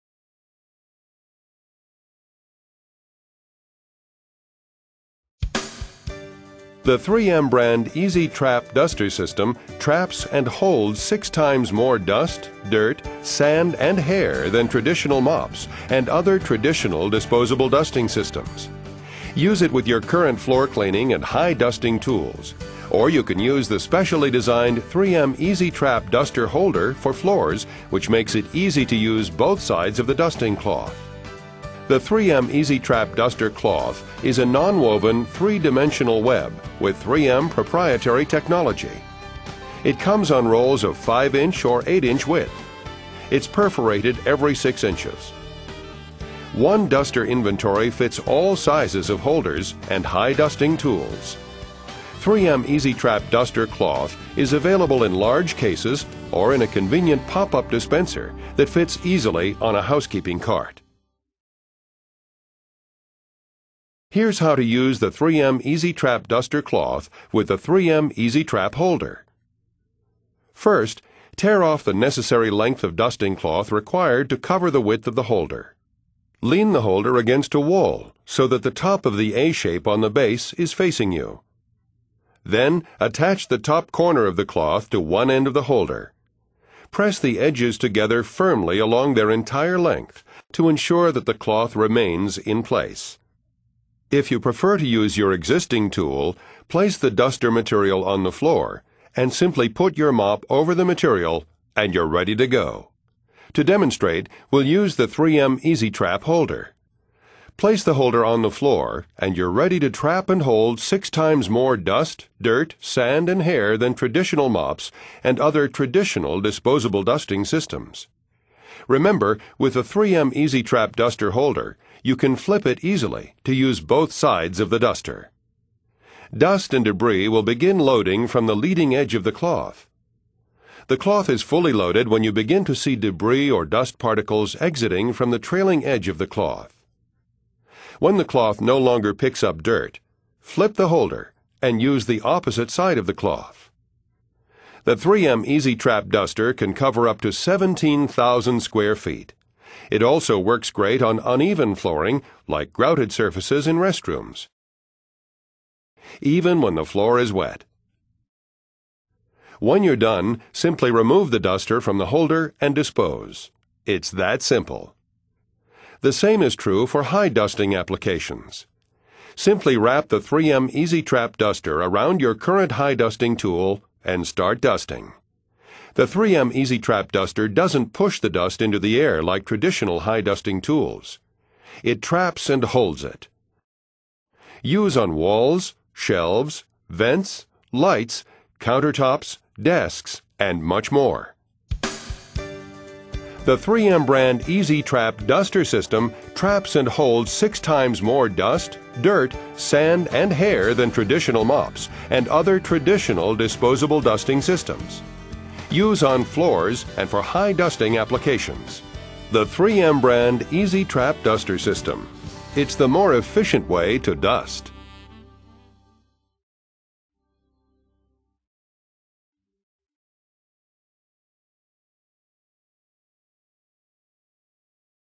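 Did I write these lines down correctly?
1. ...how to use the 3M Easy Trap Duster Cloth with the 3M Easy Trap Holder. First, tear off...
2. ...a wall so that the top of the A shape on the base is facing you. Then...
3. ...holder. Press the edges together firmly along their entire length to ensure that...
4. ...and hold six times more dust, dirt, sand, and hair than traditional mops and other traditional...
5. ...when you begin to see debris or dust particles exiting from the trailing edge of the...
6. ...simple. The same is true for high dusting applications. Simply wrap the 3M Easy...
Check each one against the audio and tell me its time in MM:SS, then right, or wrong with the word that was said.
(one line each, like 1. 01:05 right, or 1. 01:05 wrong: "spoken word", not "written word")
1. 01:04 right
2. 01:17 right
3. 01:25 right
4. 01:50 right
5. 02:12 right
6. 02:44 right.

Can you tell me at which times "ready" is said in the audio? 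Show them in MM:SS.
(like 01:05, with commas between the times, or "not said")
01:42, 01:49.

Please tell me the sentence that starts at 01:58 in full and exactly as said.
Remember, with a 3M Easy Trap duster holder, you can flip it easily to use both sides of the duster.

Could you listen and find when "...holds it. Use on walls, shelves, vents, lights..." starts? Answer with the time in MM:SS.
03:02.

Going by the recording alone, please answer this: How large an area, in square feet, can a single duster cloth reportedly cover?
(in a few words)
17,000 square feet.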